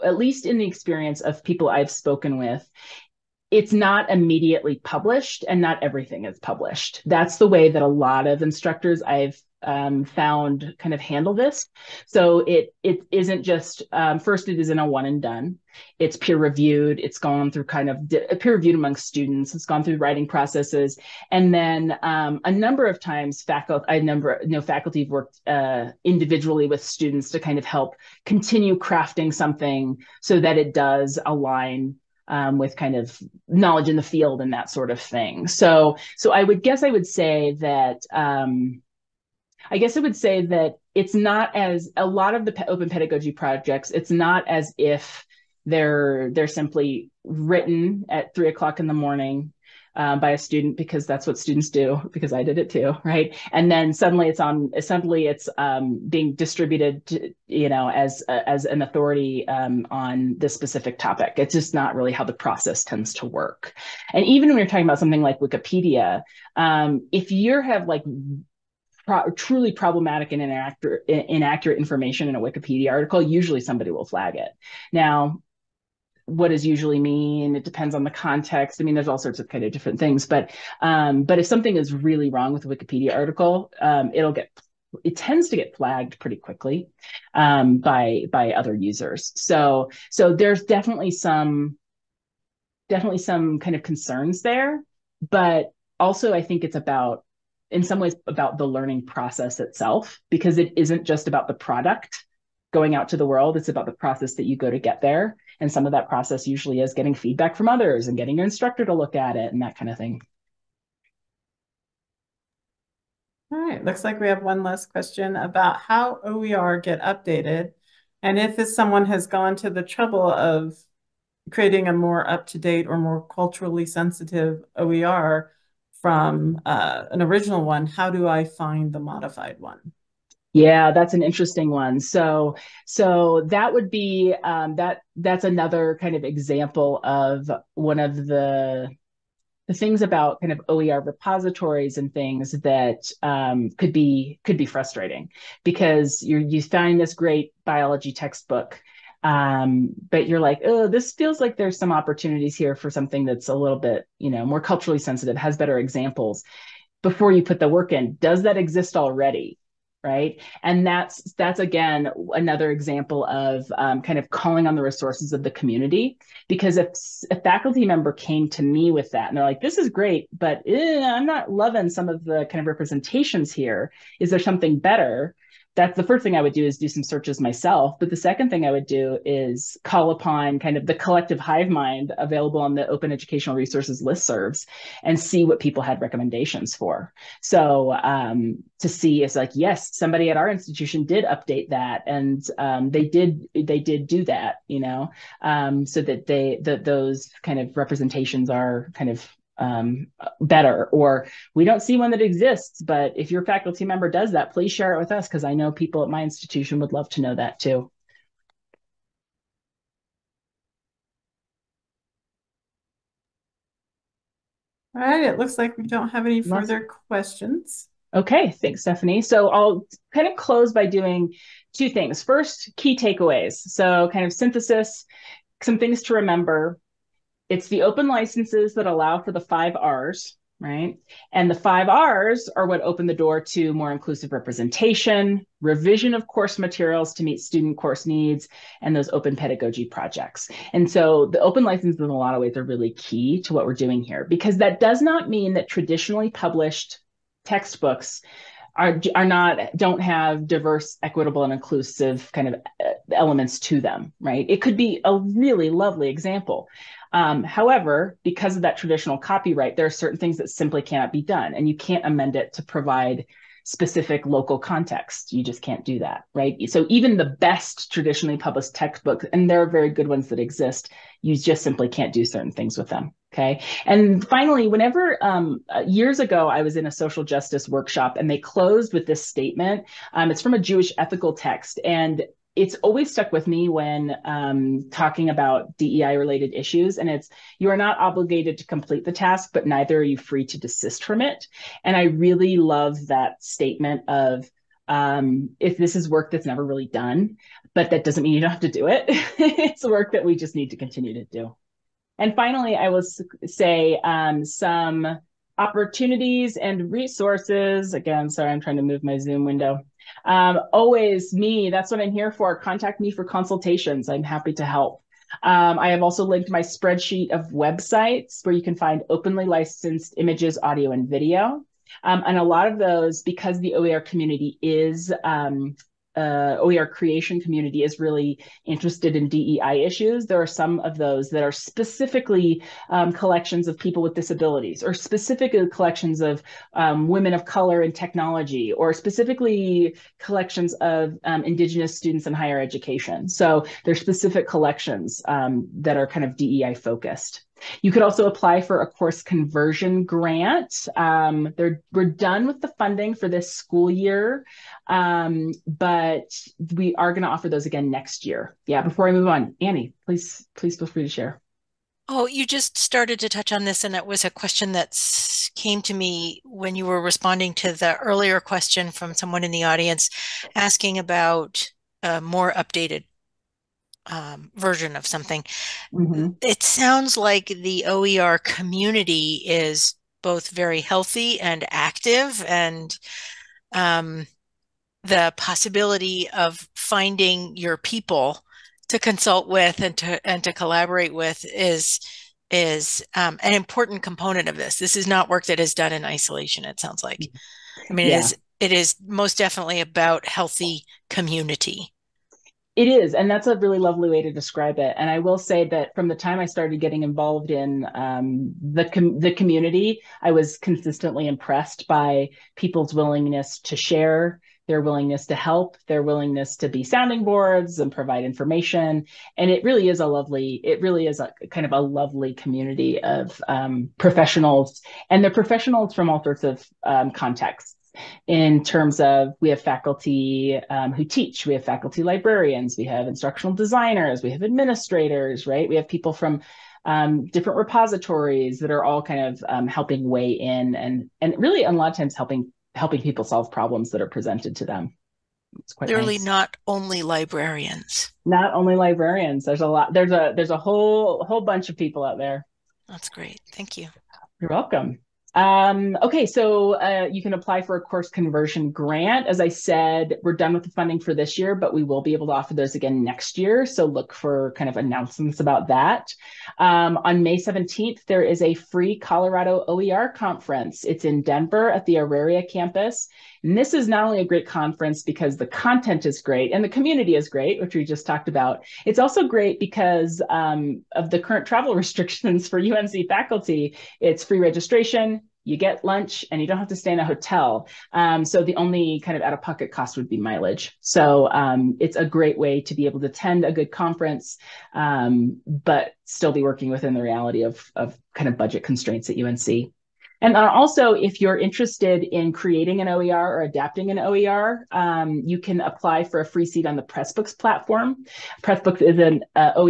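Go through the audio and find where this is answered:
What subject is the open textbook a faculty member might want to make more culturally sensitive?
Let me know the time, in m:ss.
2:27.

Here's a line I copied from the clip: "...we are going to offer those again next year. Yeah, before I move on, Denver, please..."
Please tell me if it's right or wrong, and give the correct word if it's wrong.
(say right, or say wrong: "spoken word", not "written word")
wrong: "Annie", not "Denver".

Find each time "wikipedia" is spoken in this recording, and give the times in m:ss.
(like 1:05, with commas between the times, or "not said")
1:05, 1:12, 1:22.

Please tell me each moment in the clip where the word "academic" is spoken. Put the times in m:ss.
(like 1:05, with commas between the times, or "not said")
not said.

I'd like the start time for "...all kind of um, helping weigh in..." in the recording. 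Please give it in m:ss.
7:18.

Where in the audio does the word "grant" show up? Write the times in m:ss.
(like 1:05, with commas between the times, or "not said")
5:50, 7:38.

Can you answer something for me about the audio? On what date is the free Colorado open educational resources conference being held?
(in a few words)
May 17.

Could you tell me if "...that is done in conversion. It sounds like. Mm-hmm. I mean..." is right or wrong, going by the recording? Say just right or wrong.
wrong.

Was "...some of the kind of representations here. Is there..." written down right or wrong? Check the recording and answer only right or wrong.
right.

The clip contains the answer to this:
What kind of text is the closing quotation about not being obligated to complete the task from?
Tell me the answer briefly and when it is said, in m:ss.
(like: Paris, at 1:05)
A Jewish ethical text, at 4:40.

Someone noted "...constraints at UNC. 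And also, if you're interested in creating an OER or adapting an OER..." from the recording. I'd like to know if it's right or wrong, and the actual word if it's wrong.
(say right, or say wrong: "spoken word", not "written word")
right.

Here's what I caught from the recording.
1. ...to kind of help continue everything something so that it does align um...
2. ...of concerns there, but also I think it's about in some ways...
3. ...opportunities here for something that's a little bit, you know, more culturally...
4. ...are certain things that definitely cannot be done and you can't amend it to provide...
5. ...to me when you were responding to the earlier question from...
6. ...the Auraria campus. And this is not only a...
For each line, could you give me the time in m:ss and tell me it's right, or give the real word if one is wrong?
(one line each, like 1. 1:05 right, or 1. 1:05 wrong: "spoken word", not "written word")
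1. 0:27 wrong: "crafting", not "everything"
2. 1:33 right
3. 2:31 right
4. 4:19 wrong: "simply", not "definitely"
5. 6:05 right
6. 7:51 right.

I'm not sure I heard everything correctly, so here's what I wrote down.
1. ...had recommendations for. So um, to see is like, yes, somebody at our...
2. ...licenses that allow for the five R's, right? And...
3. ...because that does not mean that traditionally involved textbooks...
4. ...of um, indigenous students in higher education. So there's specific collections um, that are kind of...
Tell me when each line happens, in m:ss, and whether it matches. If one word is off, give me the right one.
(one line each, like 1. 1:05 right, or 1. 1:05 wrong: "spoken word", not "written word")
1. 3:05 right
2. 3:48 right
3. 4:04 wrong: "published", not "involved"
4. 5:40 right.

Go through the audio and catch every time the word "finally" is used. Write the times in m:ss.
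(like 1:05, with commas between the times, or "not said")
4:34, 5:02.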